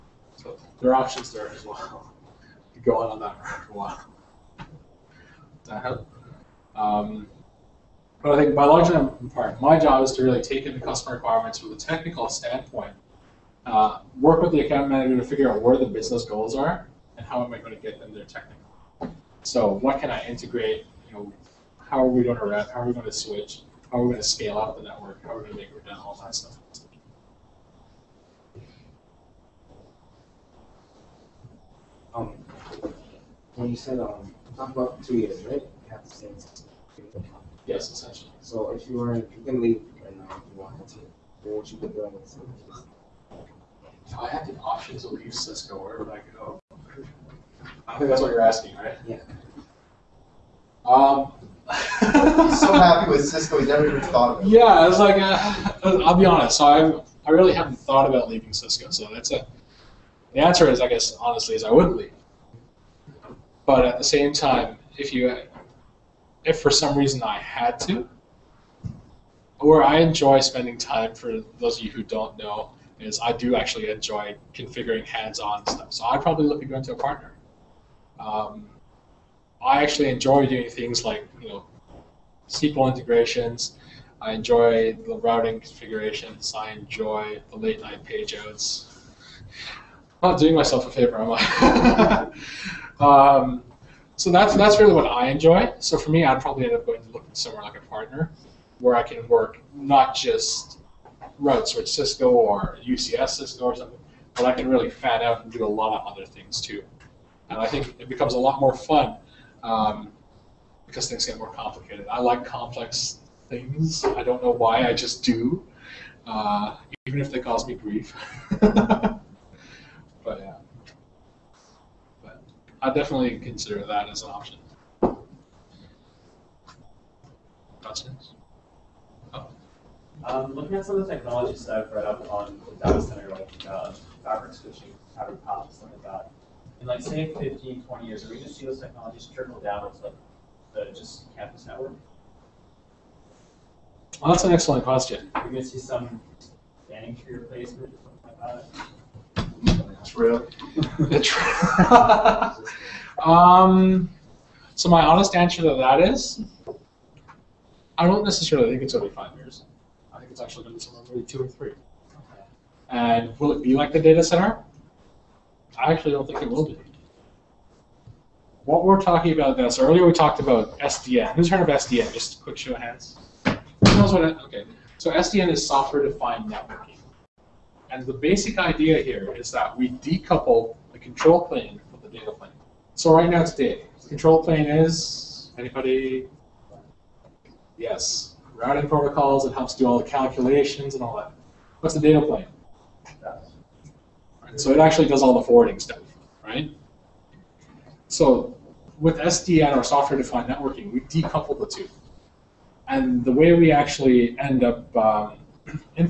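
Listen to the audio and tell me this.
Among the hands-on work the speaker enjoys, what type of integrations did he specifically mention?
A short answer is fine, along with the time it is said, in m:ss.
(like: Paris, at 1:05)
SQL integrations, at 1:22.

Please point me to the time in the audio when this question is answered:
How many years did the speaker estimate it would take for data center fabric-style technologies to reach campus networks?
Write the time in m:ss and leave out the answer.
2:41.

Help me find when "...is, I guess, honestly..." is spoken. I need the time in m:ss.
1:00.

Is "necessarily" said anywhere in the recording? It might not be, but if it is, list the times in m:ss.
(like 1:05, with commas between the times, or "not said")
2:38.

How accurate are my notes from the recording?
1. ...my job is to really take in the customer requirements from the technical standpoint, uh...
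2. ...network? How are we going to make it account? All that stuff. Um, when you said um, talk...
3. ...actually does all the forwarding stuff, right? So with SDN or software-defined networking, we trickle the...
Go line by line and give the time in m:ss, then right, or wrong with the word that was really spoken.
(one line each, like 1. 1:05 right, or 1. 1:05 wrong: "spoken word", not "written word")
1. 0:09 right
2. 0:24 wrong: "redundant", not "account"
3. 3:14 wrong: "decouple", not "trickle".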